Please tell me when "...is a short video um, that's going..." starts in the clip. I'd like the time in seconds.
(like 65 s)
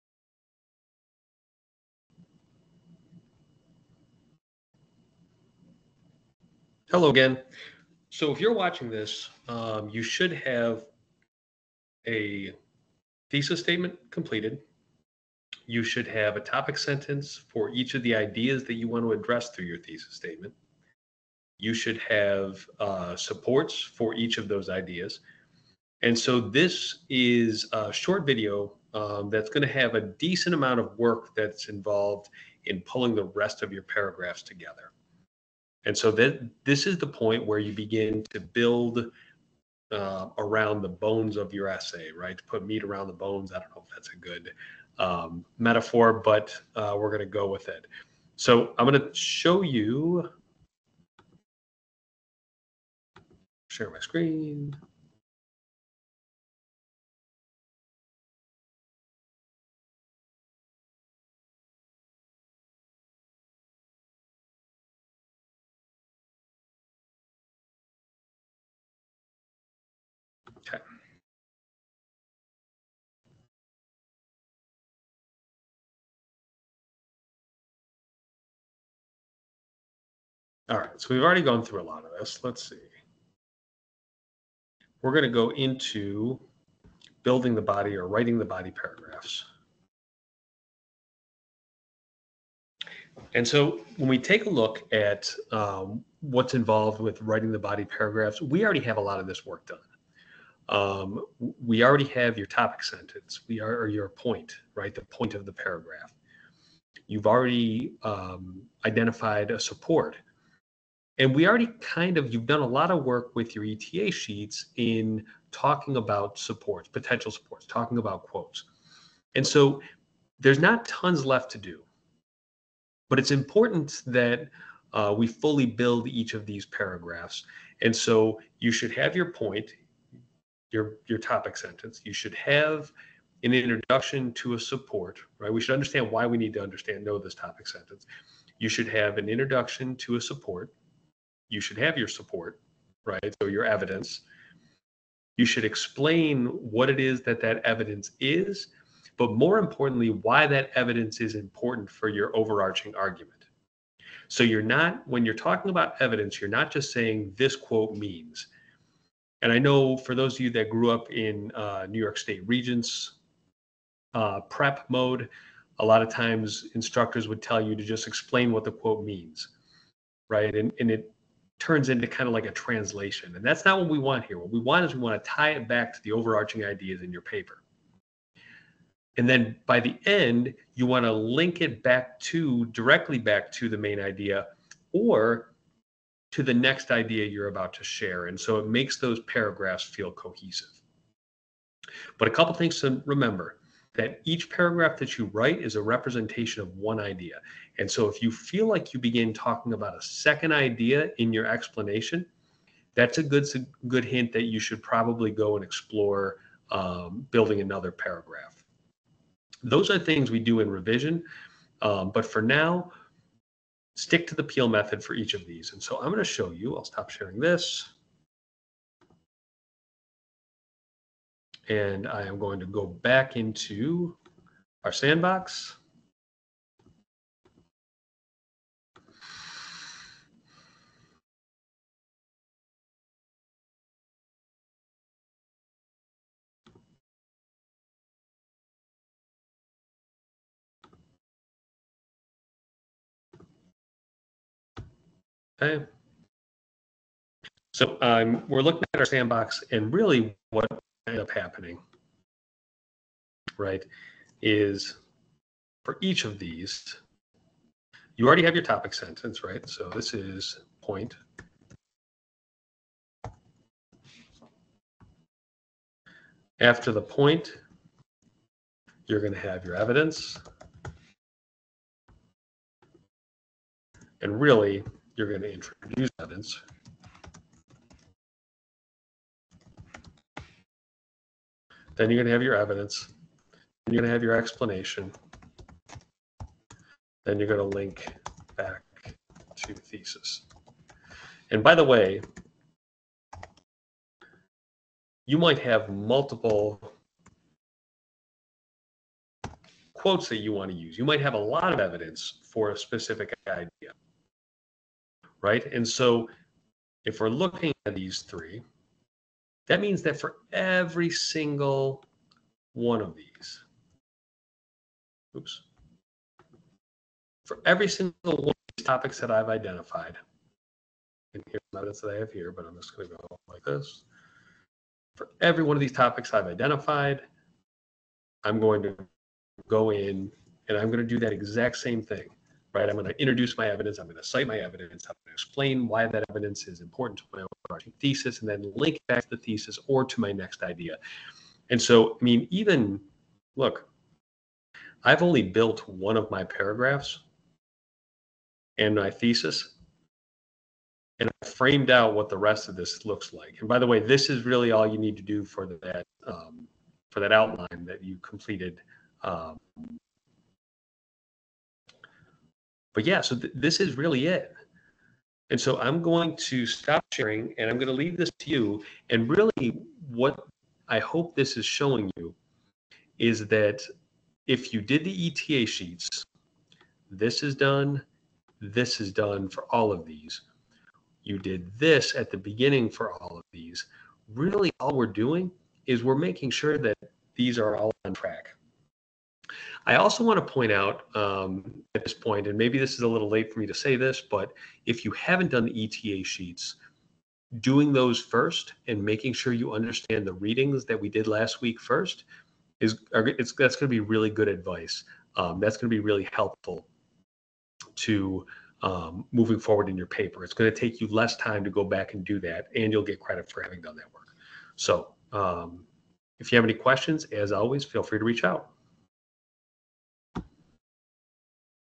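27 s.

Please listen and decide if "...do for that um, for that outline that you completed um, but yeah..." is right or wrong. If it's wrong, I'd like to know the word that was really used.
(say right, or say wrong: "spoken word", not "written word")
right.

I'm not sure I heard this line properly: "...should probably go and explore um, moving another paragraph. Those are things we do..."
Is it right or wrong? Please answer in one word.
wrong.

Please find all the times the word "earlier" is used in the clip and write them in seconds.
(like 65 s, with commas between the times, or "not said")
not said.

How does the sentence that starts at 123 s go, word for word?
But it's important that uh, we fully build each of these paragraphs.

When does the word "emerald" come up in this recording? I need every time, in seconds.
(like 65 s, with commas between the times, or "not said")
not said.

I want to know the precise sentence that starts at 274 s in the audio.
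And really, you're going to introduce evidence.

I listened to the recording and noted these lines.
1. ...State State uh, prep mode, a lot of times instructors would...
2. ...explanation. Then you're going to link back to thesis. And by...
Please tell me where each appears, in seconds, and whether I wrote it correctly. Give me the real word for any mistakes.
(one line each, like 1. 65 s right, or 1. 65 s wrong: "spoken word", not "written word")
1. 162 s wrong: "Regents", not "State"
2. 284 s right.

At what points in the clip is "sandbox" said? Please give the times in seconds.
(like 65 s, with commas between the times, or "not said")
224 s, 249 s.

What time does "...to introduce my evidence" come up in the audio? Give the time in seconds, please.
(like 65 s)
333 s.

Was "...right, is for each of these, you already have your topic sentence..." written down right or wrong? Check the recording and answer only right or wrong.
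right.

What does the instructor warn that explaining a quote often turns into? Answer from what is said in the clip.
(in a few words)
translation.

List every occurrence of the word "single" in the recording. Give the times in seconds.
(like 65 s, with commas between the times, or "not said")
311 s, 317 s.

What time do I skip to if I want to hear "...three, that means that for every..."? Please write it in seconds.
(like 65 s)
308 s.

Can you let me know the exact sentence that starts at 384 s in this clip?
Really, all we're doing is we're making sure that these are all on track.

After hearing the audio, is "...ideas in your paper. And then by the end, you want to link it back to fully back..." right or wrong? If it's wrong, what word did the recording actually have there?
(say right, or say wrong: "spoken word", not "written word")
wrong: "directly", not "fully".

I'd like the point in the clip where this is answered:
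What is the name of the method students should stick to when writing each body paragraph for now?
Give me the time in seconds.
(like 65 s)
214 s.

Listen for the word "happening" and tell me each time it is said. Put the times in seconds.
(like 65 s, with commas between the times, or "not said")
251 s.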